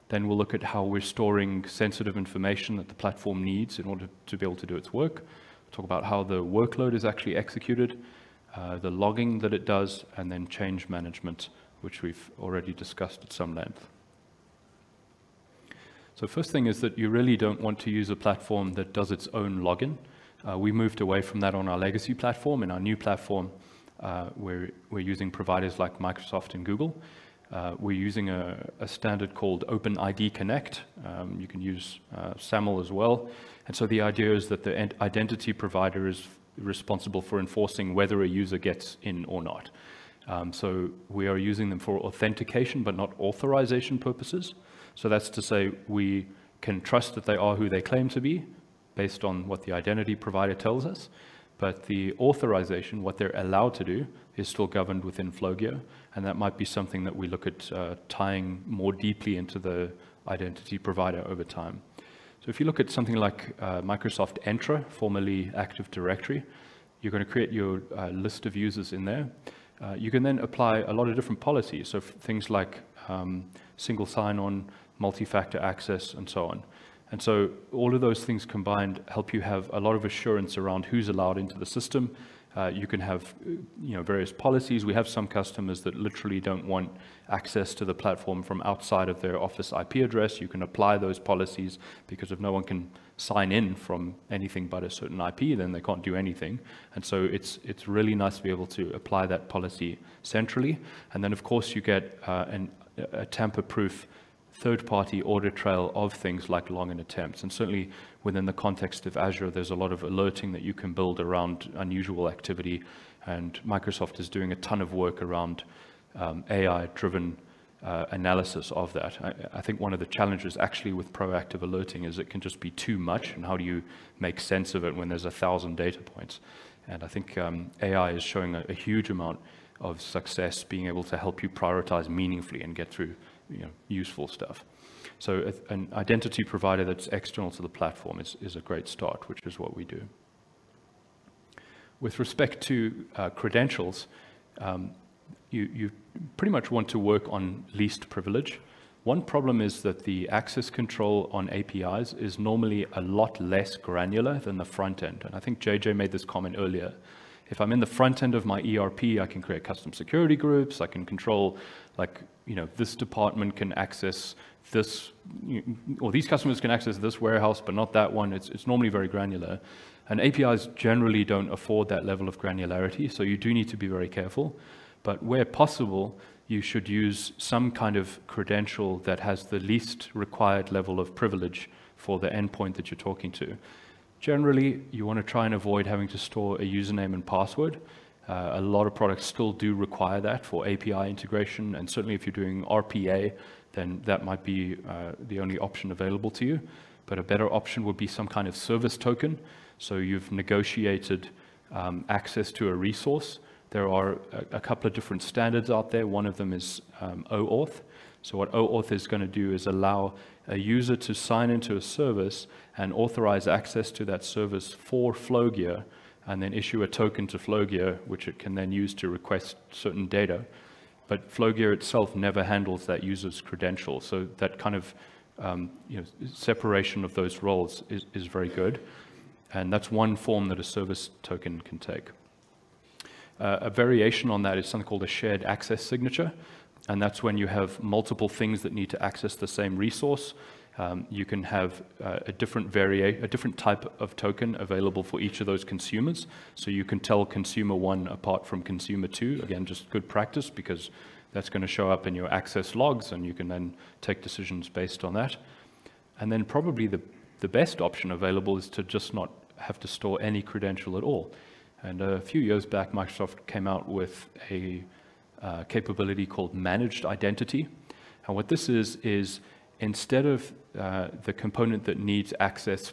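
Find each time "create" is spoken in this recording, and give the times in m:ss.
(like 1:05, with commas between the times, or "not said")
1:07, 2:39.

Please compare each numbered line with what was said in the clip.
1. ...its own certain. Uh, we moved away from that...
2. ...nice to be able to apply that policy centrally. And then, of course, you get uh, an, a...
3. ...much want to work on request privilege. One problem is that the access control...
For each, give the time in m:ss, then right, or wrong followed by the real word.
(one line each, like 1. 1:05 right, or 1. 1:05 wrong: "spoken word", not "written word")
1. 0:19 wrong: "login", not "certain"
2. 1:38 right
3. 2:26 wrong: "least", not "request".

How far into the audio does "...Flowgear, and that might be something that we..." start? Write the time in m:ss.
0:55.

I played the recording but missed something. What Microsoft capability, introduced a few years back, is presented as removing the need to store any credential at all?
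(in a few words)
managed identity.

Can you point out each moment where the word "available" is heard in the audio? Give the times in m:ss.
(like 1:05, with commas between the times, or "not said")
3:15, 4:04, 4:18.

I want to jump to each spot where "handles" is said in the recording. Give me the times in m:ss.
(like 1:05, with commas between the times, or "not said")
3:42.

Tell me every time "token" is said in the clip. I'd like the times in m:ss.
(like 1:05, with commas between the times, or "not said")
3:18, 3:36, 3:51, 4:04.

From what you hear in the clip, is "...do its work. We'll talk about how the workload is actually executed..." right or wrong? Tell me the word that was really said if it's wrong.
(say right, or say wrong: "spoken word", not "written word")
right.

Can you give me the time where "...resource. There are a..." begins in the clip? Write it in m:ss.
3:22.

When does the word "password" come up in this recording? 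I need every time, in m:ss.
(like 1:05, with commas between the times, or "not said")
3:07.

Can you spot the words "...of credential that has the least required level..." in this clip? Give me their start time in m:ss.
2:57.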